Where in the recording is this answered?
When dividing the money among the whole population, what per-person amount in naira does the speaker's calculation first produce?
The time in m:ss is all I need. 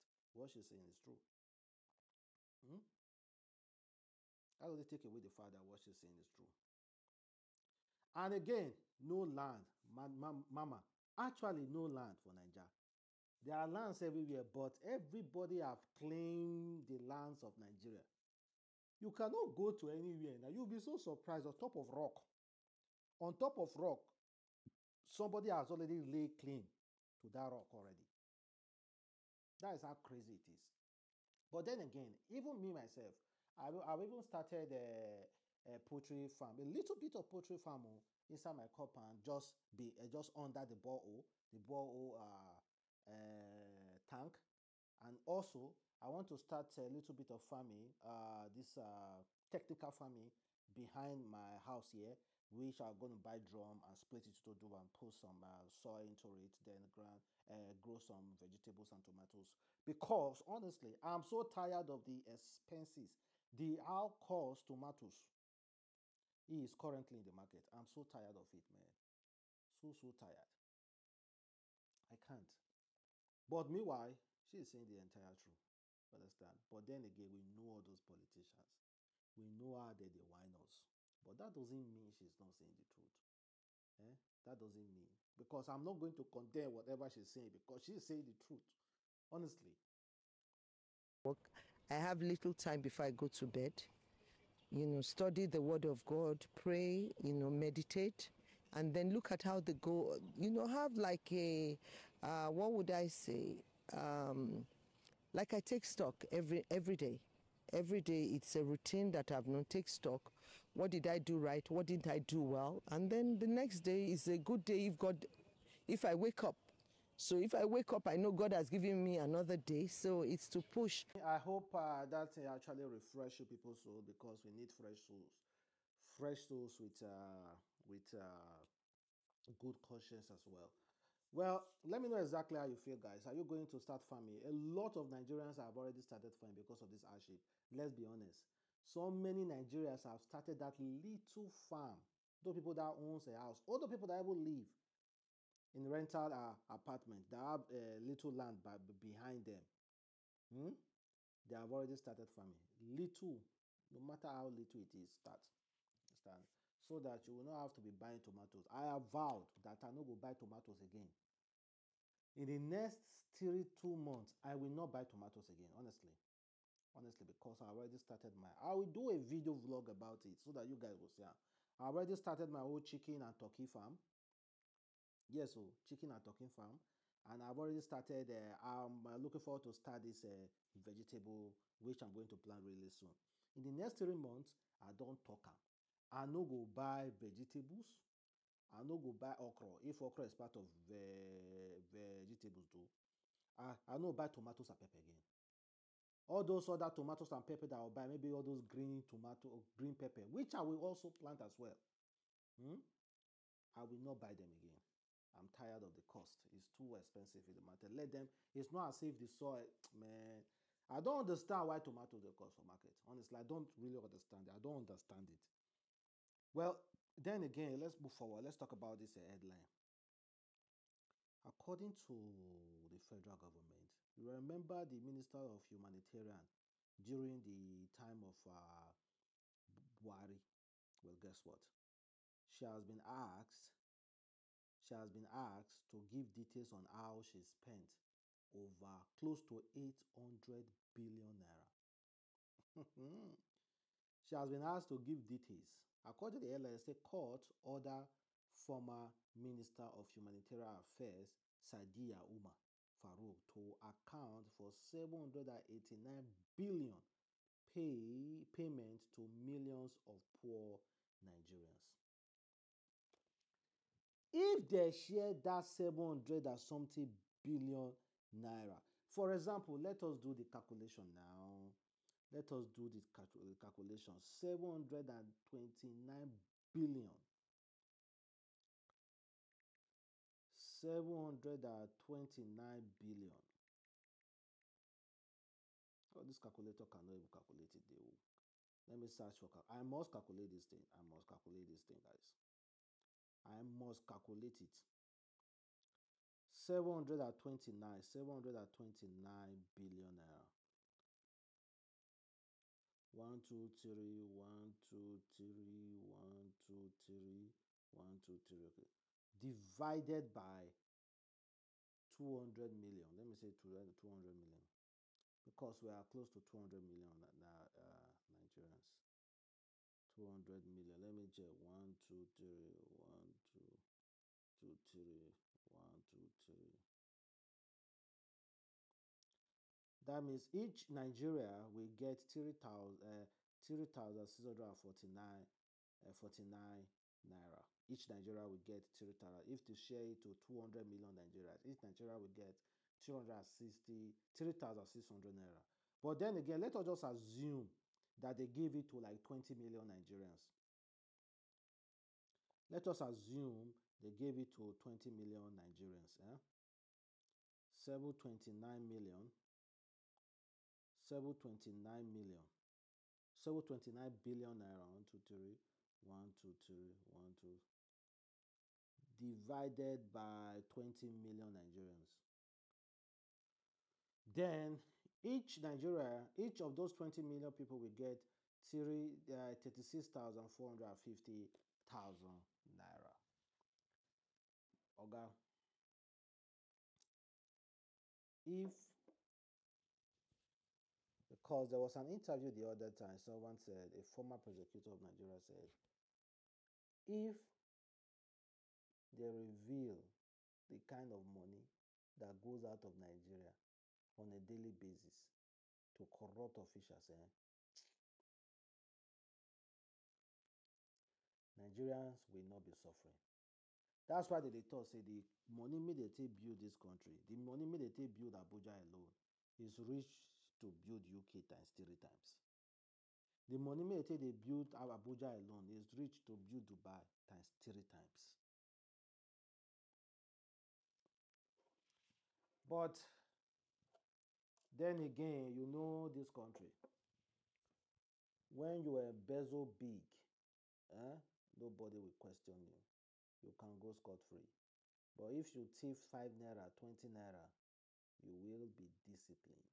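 5:32.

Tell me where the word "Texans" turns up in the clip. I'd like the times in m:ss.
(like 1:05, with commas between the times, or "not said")
not said.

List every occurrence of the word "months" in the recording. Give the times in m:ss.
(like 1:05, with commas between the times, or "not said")
2:43, 3:04.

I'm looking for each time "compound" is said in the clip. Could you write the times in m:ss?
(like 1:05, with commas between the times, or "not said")
0:38.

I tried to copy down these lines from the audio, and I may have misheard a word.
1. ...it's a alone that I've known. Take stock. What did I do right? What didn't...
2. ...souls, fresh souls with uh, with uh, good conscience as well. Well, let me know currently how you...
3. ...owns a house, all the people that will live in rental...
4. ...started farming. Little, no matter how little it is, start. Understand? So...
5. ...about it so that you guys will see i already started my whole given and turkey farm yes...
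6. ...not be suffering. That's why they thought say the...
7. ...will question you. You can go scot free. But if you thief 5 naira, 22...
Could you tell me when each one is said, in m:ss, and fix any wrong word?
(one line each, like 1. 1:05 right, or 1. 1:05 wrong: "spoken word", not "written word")
1. 1:48 wrong: "routine", not "alone"
2. 2:05 wrong: "exactly", not "currently"
3. 2:22 right
4. 2:31 right
5. 2:49 wrong: "chicken", not "given"
6. 6:52 right
7. 7:21 wrong: "20", not "22".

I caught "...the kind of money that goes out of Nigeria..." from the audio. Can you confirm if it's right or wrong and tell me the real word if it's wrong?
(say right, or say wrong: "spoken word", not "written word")
right.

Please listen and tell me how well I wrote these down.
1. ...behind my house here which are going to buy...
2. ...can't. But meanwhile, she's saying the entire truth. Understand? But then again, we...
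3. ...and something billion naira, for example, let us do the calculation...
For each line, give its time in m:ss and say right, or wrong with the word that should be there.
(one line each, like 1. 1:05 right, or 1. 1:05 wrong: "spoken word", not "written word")
1. 0:50 right
2. 1:12 right
3. 4:26 right.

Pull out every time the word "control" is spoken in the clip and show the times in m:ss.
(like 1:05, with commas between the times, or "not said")
not said.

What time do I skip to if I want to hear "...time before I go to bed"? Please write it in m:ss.
1:32.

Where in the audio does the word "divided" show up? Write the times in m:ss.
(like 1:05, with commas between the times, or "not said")
5:09, 6:09.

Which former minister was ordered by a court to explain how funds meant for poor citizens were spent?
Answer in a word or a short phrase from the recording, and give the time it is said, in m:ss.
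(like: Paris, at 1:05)
Sadia Umar Farouk, at 4:11.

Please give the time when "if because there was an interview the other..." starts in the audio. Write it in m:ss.
6:28.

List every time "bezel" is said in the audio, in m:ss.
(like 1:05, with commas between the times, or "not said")
7:19.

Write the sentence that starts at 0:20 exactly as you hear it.
You'll be so surprised on top of rock.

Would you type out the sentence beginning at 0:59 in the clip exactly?
Because honestly, I'm so tired of the expenses.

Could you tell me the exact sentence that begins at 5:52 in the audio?
Let us assume they gave it to 20 million Nigerians.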